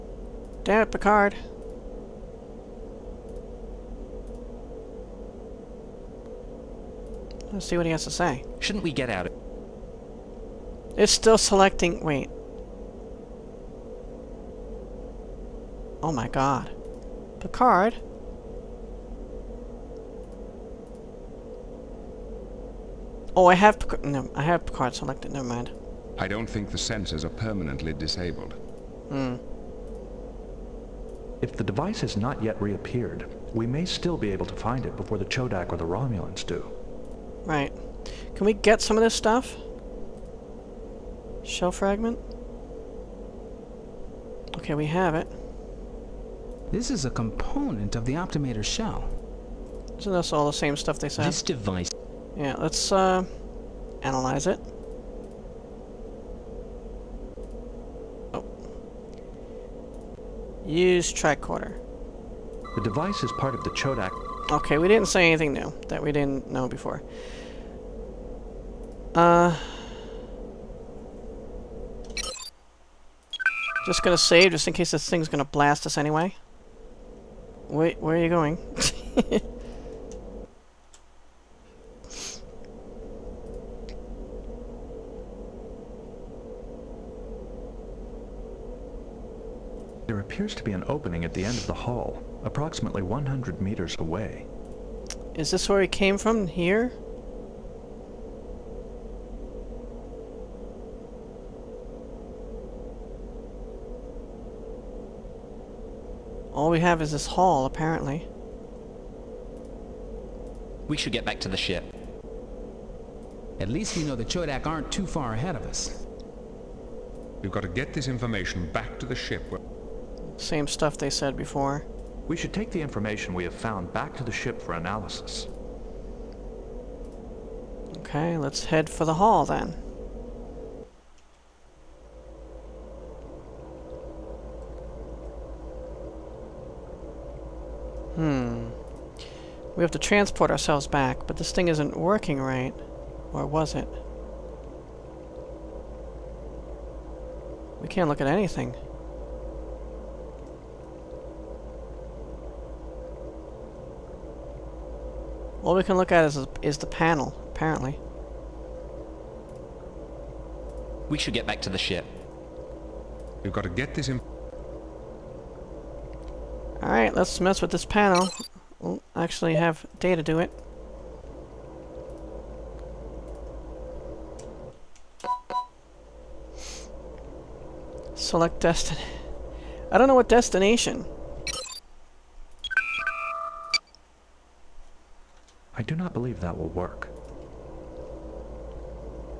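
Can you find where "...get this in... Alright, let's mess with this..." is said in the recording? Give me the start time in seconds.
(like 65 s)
163 s.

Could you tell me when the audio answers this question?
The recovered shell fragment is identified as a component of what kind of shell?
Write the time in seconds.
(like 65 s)
48 s.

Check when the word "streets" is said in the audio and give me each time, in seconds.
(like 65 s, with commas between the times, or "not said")
not said.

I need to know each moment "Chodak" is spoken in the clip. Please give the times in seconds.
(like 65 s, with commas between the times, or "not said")
35 s, 63 s, 114 s.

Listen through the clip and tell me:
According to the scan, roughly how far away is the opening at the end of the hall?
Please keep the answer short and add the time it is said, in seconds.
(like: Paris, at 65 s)
100 meters, at 93 s.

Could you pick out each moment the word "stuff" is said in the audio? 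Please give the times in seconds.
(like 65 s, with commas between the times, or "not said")
39 s, 50 s, 120 s.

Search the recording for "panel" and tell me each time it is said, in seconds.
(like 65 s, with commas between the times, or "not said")
156 s, 167 s.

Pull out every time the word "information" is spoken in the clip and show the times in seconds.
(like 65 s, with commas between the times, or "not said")
118 s, 122 s.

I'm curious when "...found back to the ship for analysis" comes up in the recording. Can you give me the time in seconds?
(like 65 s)
123 s.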